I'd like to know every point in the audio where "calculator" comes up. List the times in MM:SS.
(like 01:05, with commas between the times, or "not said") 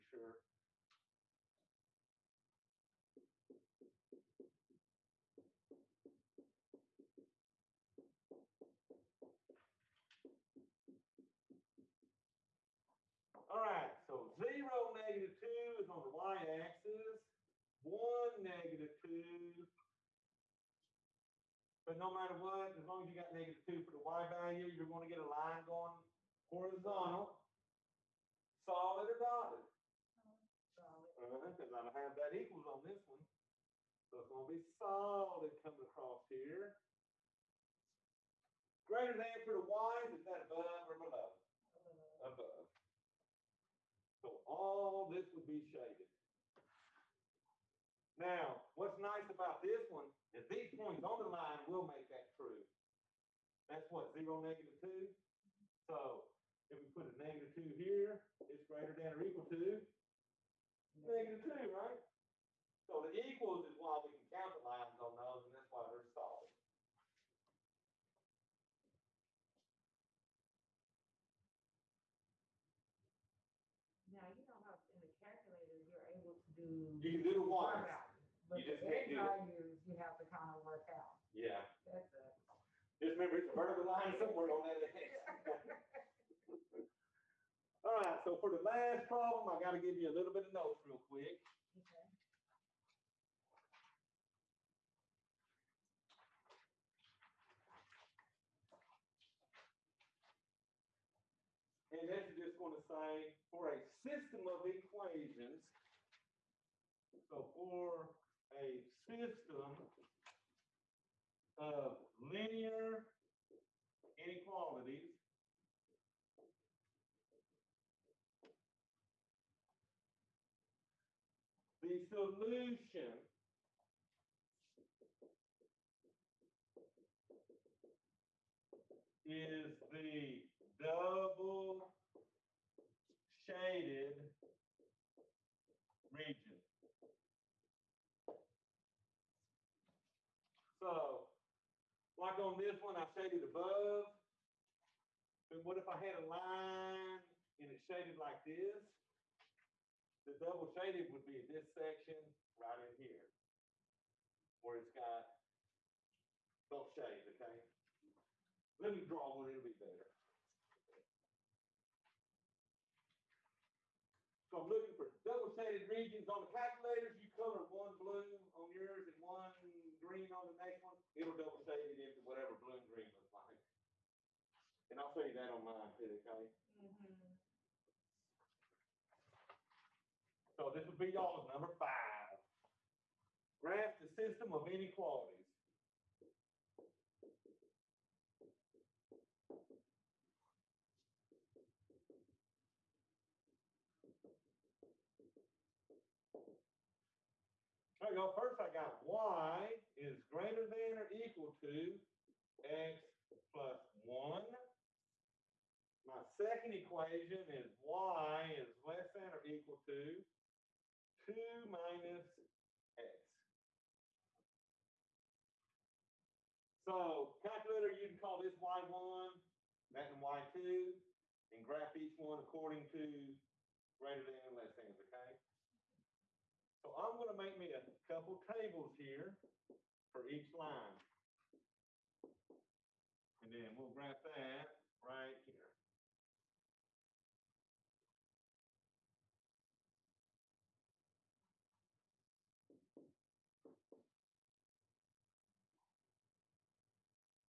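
01:15, 02:46, 03:37.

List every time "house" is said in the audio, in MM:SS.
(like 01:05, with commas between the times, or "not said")
not said.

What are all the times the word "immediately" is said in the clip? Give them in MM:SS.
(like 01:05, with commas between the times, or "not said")
not said.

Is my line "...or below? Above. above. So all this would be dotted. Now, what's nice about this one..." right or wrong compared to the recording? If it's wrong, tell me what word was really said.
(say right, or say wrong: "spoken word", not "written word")
wrong: "shaded", not "dotted".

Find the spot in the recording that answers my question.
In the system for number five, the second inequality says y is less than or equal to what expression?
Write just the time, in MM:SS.
03:31.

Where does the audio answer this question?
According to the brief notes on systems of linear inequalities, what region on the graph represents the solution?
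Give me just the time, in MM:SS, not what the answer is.
02:09.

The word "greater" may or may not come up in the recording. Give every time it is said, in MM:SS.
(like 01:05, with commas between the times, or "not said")
00:38, 00:58, 03:20, 03:43.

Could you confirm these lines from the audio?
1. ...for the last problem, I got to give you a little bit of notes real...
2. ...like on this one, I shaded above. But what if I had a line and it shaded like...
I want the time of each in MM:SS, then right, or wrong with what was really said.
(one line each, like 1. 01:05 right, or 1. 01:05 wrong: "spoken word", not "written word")
1. 01:28 right
2. 02:22 right.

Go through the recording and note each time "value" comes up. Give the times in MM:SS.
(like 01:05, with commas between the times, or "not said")
00:24, 01:19.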